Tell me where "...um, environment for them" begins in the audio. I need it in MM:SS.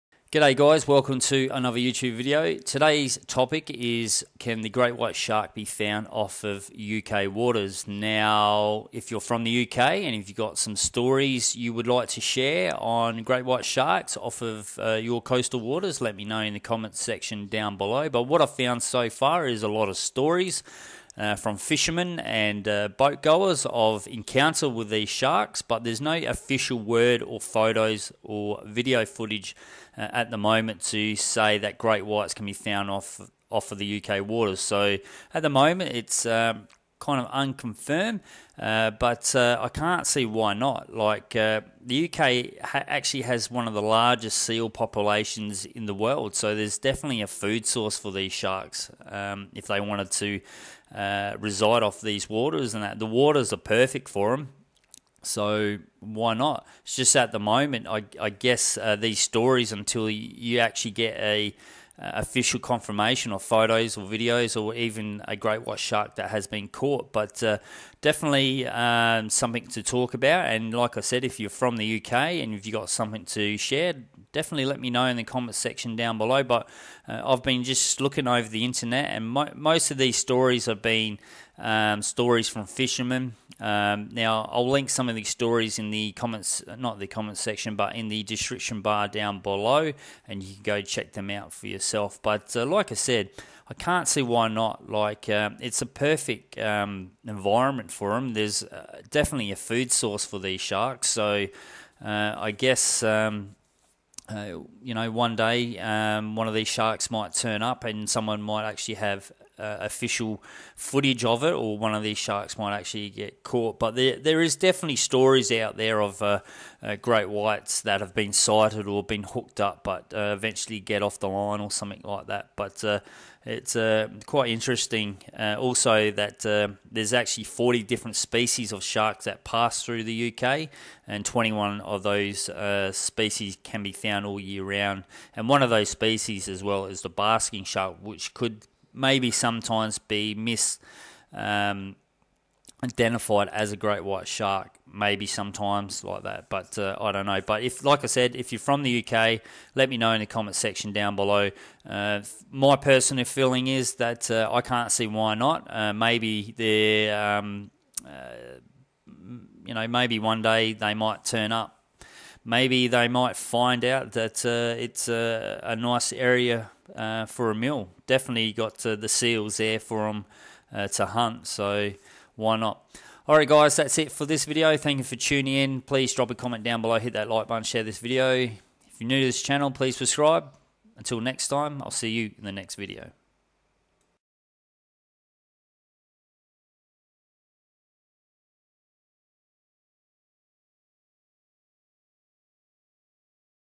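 01:36.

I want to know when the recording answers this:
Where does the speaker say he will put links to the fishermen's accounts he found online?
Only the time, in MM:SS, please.
01:28.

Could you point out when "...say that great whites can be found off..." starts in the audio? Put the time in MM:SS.
00:31.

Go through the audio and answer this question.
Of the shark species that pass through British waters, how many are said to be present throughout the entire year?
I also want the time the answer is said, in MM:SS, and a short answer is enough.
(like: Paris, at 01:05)
21, at 02:11.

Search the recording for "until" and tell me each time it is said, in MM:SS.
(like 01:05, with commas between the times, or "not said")
00:59, 03:00.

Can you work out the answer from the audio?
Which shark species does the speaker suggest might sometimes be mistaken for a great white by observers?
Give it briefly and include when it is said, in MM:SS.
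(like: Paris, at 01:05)
Basking shark, at 02:17.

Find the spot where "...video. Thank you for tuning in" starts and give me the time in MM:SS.
02:54.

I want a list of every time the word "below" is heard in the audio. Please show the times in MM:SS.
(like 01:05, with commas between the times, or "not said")
00:17, 01:16, 01:29, 02:31, 02:56.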